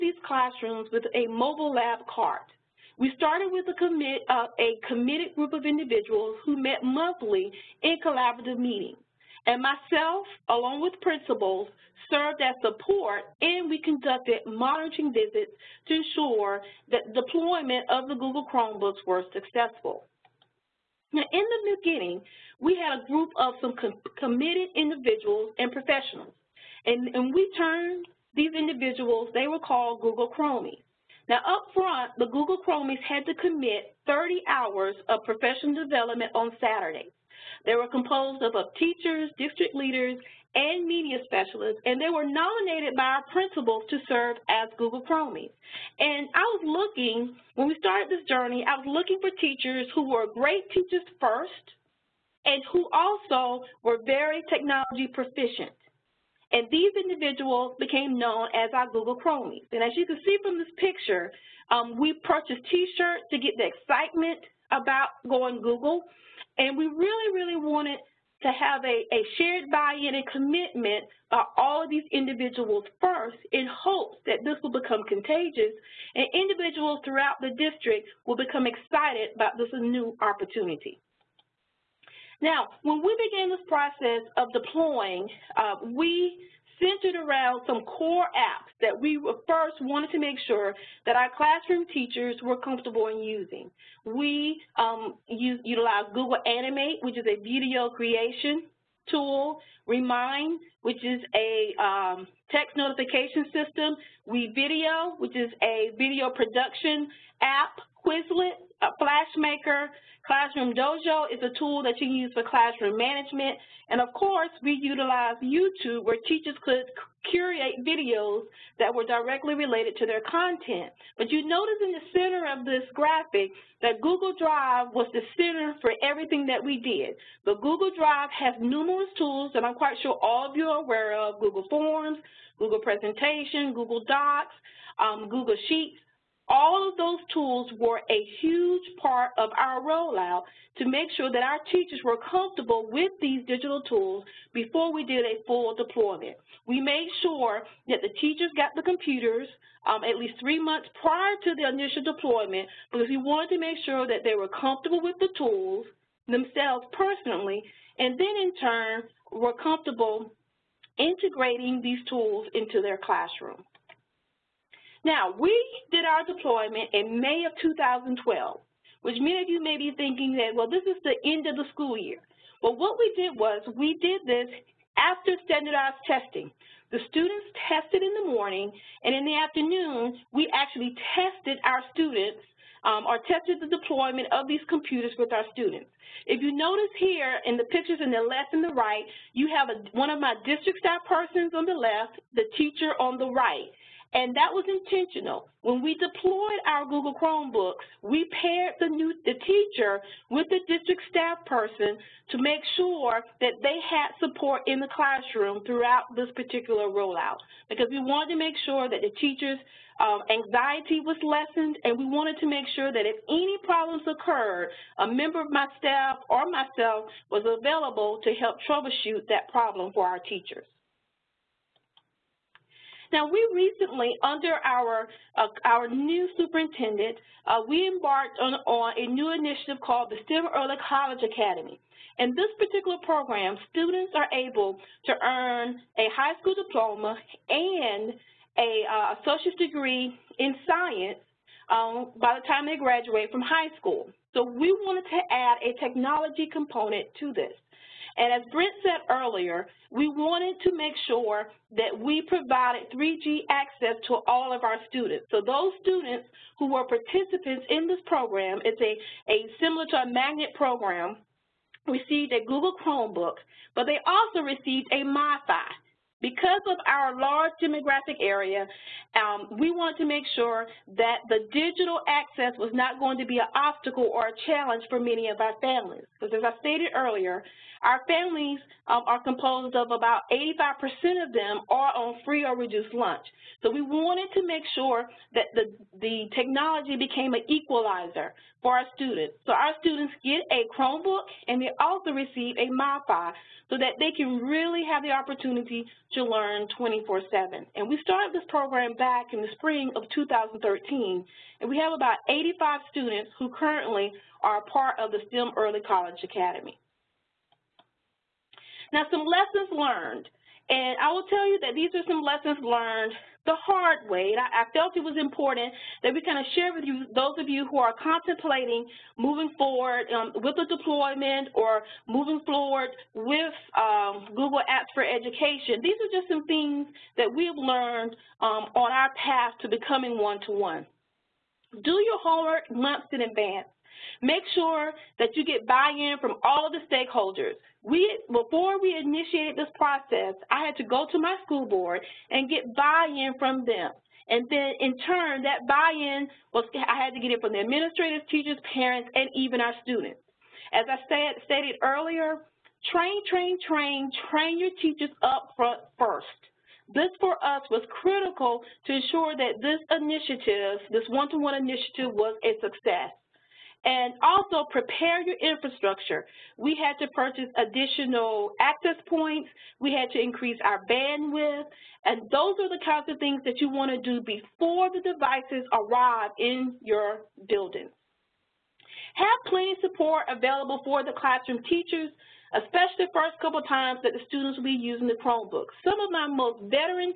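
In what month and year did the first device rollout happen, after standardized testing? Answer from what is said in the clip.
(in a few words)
May 2012.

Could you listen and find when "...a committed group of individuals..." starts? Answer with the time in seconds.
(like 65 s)
4 s.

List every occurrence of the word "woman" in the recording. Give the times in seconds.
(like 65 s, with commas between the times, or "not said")
not said.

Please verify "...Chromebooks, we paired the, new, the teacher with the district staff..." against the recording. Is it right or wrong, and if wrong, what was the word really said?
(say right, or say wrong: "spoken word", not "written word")
right.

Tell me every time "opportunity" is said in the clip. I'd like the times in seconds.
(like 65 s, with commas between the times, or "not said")
80 s, 295 s.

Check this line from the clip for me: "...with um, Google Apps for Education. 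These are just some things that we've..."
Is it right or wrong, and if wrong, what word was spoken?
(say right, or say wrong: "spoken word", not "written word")
right.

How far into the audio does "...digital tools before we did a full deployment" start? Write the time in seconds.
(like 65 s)
143 s.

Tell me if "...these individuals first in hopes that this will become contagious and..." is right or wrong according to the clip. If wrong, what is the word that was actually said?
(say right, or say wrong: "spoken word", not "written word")
right.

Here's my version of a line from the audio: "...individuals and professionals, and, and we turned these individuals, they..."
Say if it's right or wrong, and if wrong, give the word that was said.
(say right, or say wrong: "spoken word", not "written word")
right.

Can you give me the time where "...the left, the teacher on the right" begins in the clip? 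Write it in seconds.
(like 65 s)
191 s.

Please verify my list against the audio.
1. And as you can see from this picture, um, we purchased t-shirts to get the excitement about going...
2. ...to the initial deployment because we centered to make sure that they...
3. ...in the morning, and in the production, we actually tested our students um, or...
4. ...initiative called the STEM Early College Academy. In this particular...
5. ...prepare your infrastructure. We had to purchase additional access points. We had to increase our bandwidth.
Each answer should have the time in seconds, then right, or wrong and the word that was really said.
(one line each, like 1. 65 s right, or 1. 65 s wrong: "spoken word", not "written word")
1. 59 s right
2. 151 s wrong: "wanted", not "centered"
3. 178 s wrong: "afternoon", not "production"
4. 229 s right
5. 364 s right.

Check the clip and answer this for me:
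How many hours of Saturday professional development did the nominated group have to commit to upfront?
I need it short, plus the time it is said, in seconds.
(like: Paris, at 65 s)
30, at 34 s.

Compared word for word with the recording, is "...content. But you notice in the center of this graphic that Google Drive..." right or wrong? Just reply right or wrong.
right.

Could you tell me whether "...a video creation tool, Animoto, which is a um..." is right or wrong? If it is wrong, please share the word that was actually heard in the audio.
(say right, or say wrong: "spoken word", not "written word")
wrong: "Remind", not "Animoto".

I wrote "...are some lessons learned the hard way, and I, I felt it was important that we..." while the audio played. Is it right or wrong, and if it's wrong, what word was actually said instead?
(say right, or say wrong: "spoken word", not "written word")
right.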